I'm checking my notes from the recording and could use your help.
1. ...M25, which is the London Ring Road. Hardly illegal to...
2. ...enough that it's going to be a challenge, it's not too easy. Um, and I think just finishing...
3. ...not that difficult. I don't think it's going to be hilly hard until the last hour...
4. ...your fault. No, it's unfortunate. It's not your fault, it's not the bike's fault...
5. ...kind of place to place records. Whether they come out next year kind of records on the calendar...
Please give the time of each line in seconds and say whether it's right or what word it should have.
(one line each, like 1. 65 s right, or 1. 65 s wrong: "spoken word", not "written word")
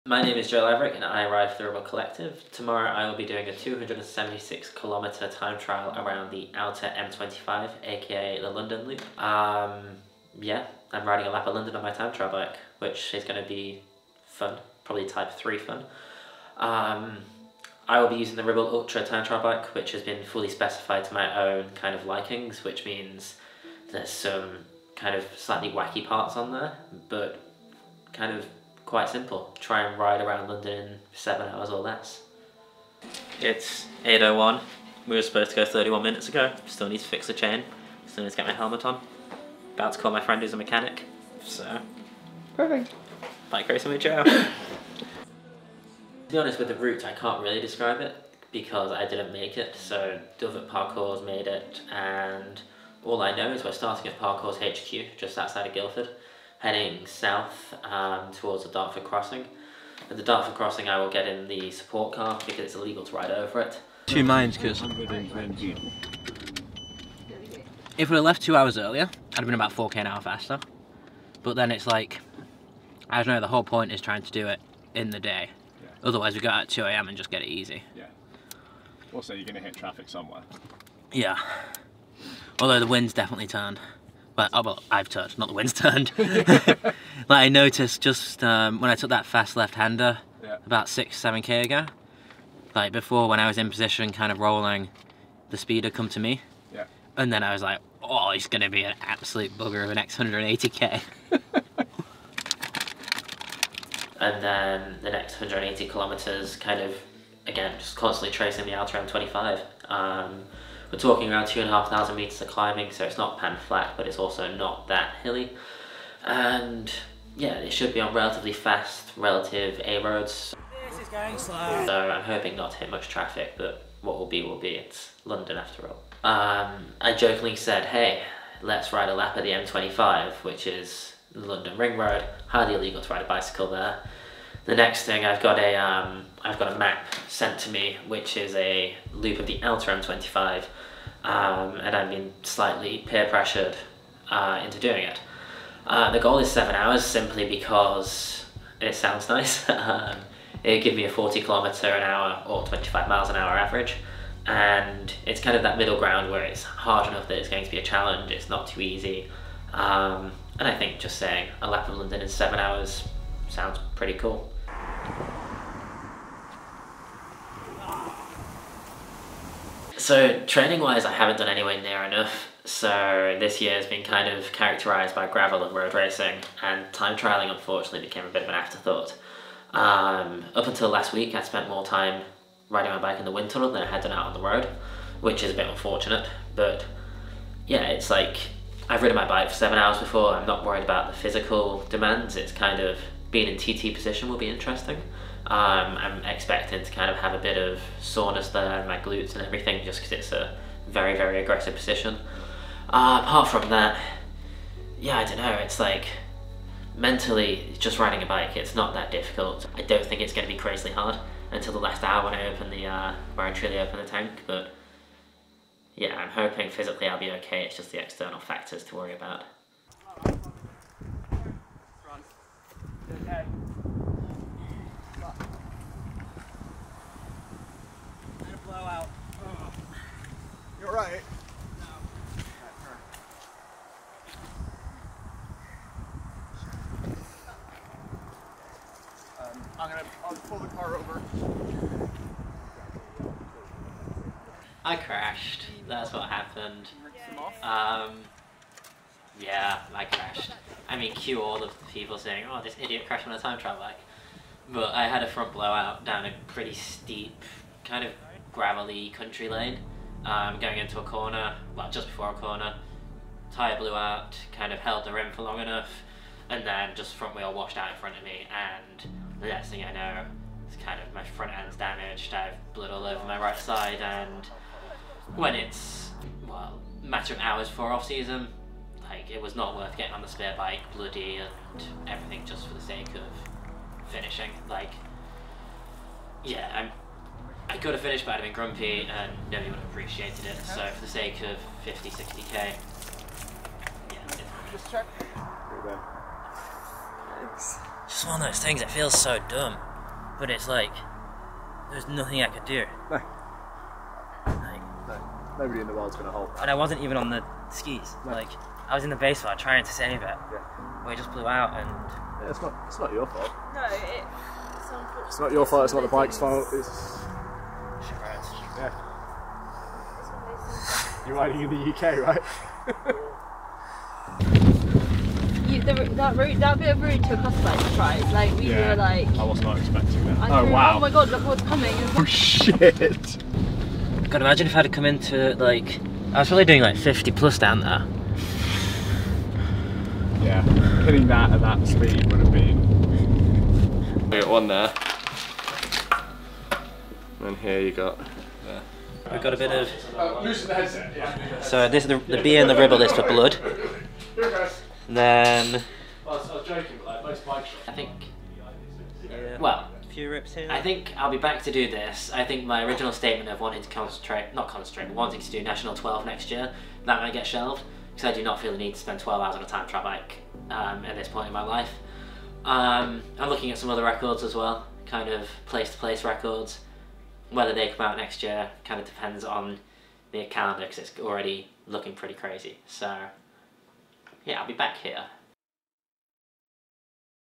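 1. 129 s right
2. 157 s wrong: "saying", not "finishing"
3. 208 s wrong: "crazily", not "hilly"
4. 313 s right
5. 375 s wrong: "depends", not "records".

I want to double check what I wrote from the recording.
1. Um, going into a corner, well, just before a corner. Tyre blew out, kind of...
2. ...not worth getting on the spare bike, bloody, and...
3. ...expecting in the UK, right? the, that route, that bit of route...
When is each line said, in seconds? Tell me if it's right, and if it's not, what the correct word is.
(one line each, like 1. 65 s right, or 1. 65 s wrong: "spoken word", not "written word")
1. 260 s right
2. 279 s right
3. 321 s wrong: "riding", not "expecting".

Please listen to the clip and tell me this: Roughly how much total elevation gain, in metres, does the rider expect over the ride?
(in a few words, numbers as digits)
2,500 metres.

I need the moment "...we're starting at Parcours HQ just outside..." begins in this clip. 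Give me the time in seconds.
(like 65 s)
53 s.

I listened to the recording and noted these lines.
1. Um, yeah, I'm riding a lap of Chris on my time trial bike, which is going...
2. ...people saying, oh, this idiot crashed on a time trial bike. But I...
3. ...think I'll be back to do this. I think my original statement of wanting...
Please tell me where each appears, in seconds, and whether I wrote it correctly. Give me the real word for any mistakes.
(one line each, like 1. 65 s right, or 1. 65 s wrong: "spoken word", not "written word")
1. 9 s wrong: "London", not "Chris"
2. 251 s right
3. 360 s right.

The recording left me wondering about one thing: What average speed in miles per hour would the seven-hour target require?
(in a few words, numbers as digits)
25 mph.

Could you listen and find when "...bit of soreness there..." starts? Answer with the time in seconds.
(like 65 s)
197 s.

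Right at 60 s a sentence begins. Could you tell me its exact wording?
At the Dartford Crossing I will get in the support car because it's illegal to ride over it.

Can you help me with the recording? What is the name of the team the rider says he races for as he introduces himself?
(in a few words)
Ribble Collective.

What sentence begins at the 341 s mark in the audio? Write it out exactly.
Opening that at that speed would have been.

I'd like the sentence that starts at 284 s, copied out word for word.
Like, yeah, I'm, I could have finished, but I'd have been grumpy, and nobody would have appreciated it.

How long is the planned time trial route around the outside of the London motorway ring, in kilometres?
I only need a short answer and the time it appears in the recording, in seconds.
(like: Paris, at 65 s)
276, at 3 s.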